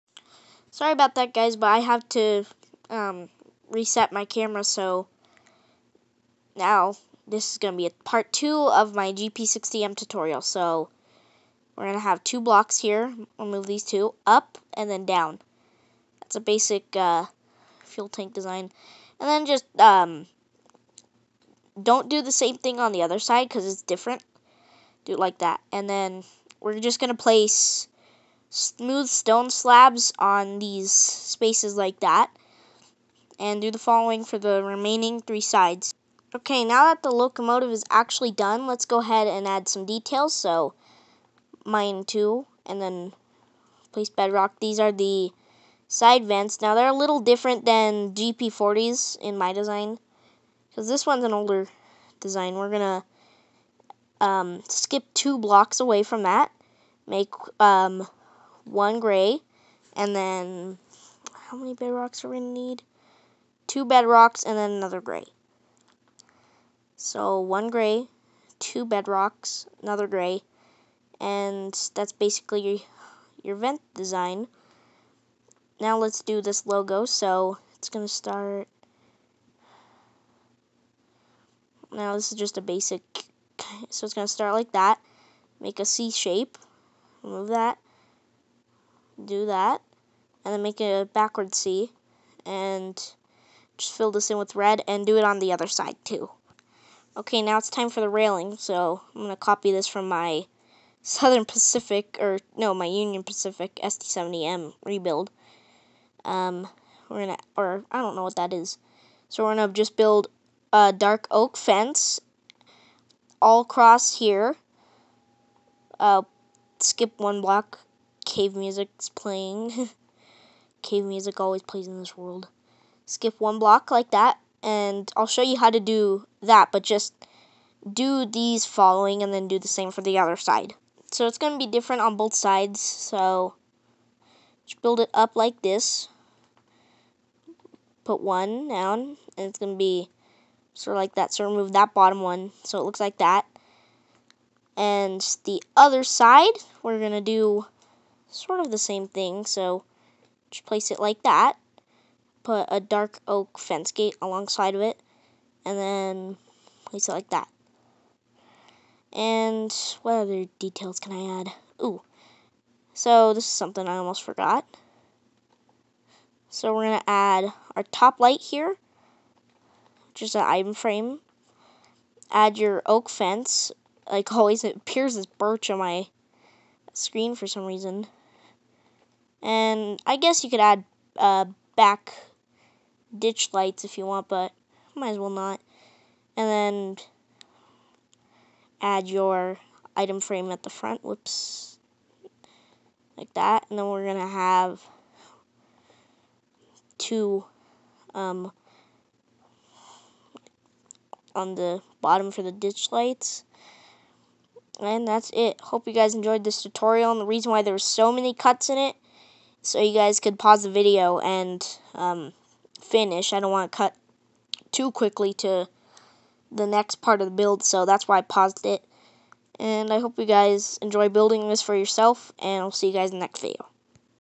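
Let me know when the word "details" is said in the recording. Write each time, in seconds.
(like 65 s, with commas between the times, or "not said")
39 s, 160 s.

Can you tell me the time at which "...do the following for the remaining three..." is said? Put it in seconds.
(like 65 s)
33 s.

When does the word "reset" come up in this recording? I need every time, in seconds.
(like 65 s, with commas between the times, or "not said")
3 s.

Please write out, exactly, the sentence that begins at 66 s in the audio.
So one gray, two bedrocks, another gray, and that's basically your, your vent design.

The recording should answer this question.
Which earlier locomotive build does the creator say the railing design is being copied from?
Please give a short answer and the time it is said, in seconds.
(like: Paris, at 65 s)
Union Pacific SD70M rebuild, at 102 s.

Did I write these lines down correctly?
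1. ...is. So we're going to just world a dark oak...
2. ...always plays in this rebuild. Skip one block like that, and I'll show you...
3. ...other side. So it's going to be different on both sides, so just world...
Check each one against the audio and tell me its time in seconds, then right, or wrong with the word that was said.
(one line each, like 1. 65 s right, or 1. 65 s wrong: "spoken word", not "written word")
1. 108 s wrong: "build", not "world"
2. 121 s wrong: "world", not "rebuild"
3. 130 s wrong: "build", not "world".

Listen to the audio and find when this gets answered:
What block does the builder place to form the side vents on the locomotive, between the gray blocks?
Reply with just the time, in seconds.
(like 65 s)
43 s.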